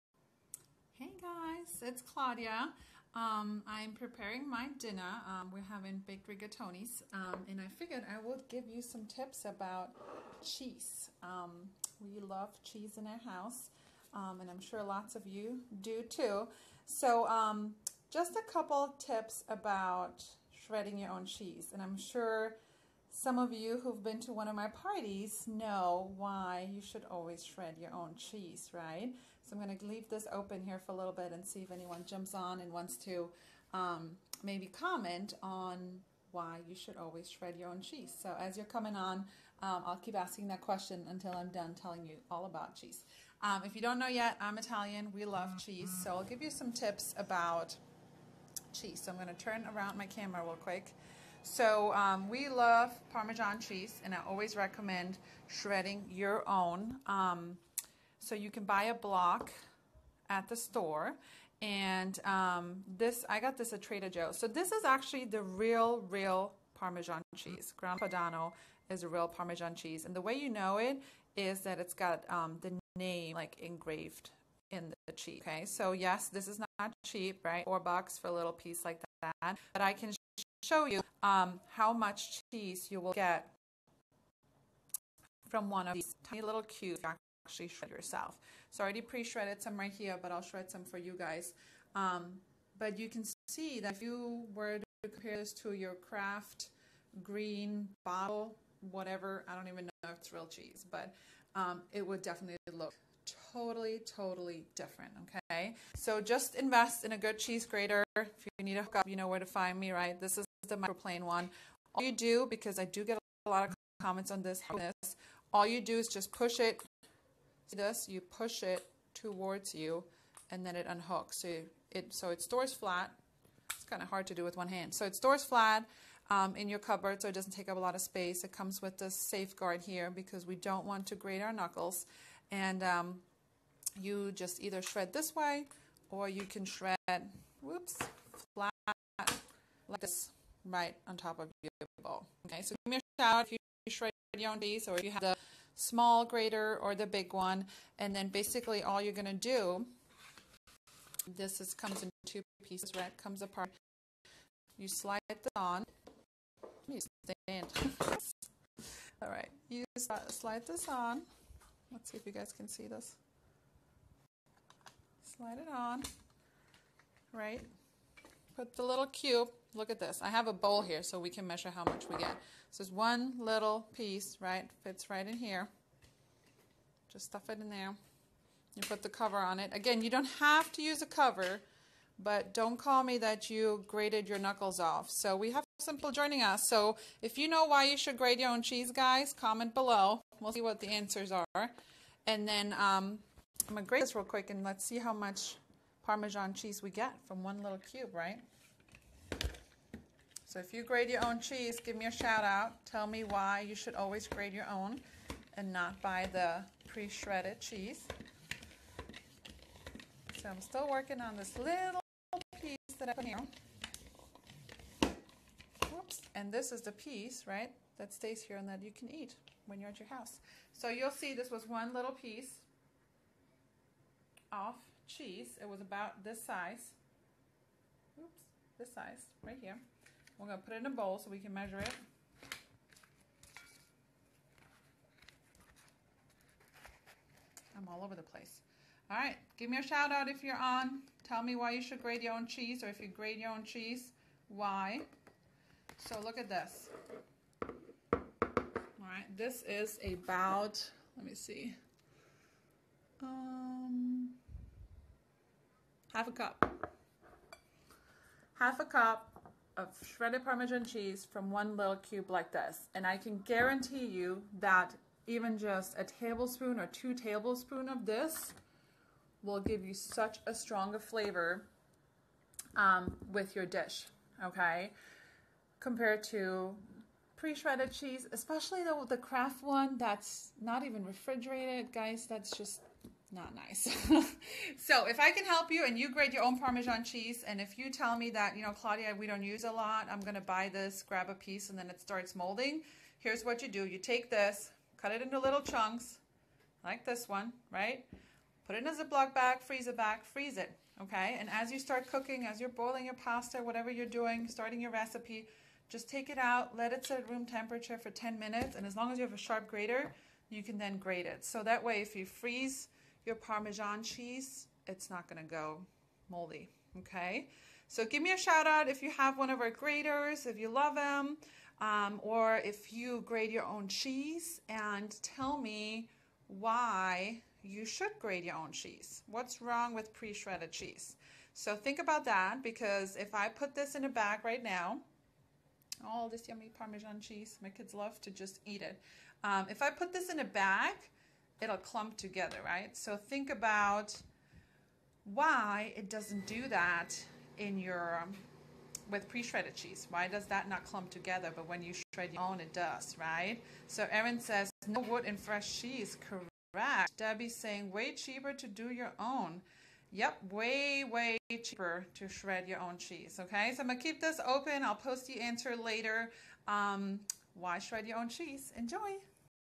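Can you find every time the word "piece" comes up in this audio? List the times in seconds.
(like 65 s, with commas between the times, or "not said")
78 s, 144 s, 152 s, 173 s, 212 s, 216 s, 222 s, 291 s.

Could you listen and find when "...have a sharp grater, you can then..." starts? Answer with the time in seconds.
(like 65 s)
309 s.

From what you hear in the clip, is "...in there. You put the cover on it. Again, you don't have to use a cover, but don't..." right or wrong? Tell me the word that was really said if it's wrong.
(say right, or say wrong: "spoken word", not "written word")
right.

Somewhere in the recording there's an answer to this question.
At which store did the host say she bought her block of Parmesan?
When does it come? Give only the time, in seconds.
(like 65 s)
63 s.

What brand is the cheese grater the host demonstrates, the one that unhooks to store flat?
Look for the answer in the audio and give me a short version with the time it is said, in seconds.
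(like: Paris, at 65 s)
Microplane, at 110 s.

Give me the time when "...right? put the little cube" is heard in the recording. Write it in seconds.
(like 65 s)
167 s.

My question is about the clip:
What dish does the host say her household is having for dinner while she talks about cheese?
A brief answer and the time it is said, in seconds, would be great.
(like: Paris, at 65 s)
baked rigatoni, at 6 s.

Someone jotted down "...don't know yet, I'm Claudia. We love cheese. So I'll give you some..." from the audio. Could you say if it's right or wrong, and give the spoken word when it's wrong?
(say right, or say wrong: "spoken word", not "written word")
wrong: "Italian", not "Claudia".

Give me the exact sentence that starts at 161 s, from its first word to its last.
Let's see if you guys can see this.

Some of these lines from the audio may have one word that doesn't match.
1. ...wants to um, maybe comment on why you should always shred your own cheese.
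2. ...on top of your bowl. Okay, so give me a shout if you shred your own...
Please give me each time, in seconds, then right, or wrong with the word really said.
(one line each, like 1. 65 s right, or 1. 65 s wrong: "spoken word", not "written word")
1. 32 s right
2. 141 s right.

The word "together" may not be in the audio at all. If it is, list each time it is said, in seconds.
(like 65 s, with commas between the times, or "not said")
342 s, 351 s.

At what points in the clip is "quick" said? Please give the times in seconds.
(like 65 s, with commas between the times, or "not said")
50 s, 194 s.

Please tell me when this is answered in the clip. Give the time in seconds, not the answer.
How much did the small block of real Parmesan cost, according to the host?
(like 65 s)
77 s.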